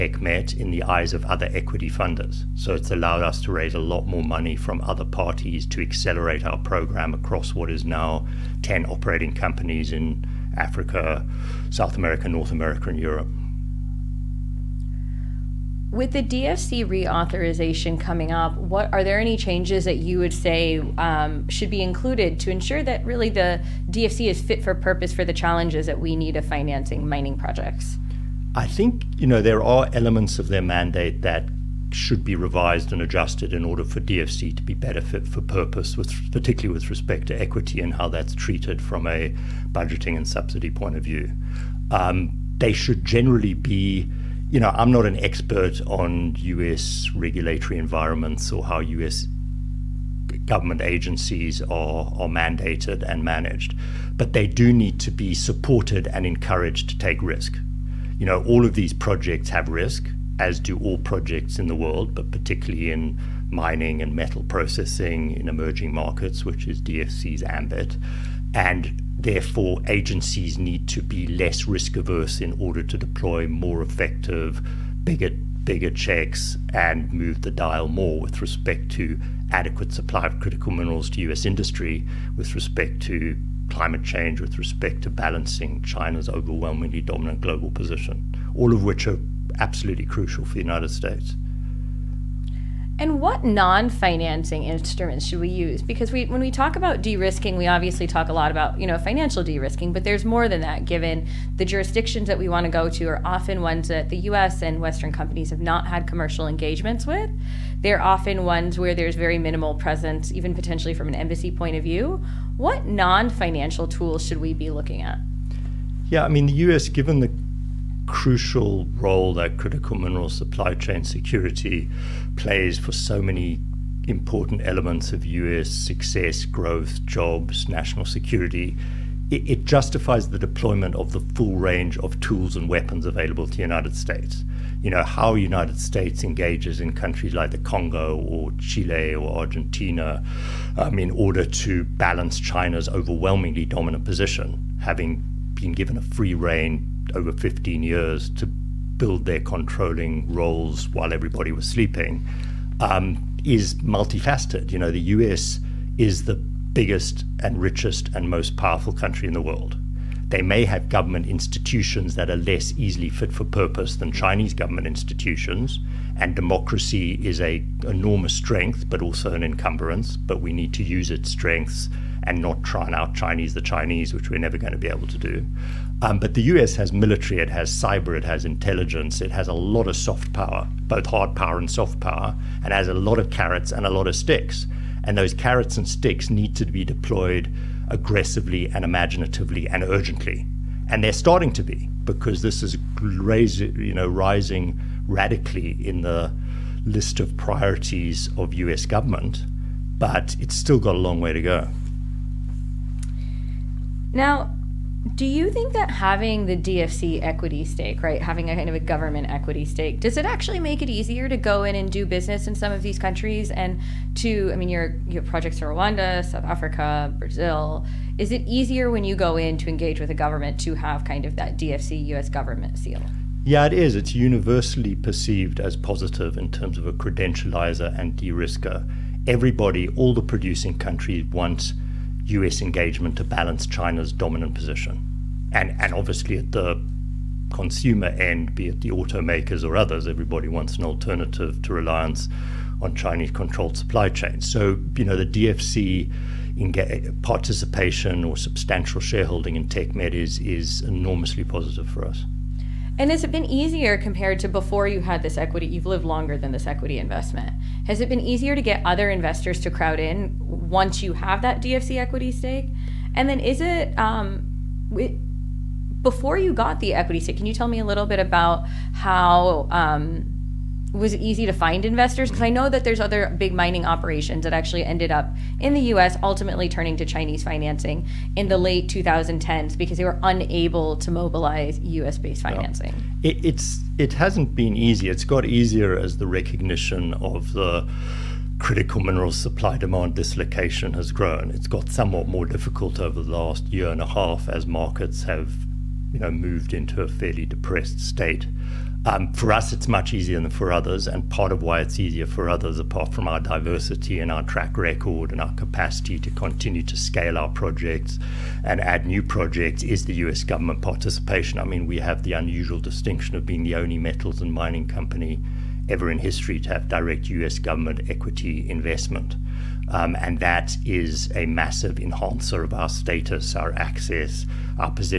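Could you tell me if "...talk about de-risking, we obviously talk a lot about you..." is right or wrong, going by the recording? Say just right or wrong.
right.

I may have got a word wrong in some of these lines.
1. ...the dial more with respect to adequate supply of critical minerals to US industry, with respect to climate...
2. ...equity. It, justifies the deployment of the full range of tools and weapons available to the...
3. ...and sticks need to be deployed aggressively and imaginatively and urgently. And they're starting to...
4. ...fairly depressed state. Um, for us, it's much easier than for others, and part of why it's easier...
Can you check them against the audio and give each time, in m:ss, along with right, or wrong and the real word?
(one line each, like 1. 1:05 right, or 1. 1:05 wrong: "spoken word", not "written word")
1. 1:17 right
2. 2:08 wrong: "security", not "equity"
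3. 3:05 right
4. 4:57 right.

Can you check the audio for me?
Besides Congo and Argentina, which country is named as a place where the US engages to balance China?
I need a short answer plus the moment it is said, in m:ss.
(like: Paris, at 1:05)
Chile, at 2:18.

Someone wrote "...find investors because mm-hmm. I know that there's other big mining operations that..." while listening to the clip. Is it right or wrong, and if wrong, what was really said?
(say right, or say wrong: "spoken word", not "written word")
right.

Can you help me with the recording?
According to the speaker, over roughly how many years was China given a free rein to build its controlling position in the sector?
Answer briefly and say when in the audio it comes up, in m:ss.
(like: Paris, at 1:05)
15 years, at 2:27.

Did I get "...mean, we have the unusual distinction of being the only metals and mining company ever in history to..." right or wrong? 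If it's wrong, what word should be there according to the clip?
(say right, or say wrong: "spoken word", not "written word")
right.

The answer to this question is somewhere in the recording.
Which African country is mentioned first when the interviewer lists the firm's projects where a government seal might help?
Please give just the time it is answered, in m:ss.
3:35.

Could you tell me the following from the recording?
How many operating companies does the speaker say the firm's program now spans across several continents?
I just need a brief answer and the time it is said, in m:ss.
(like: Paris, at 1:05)
10, at 0:08.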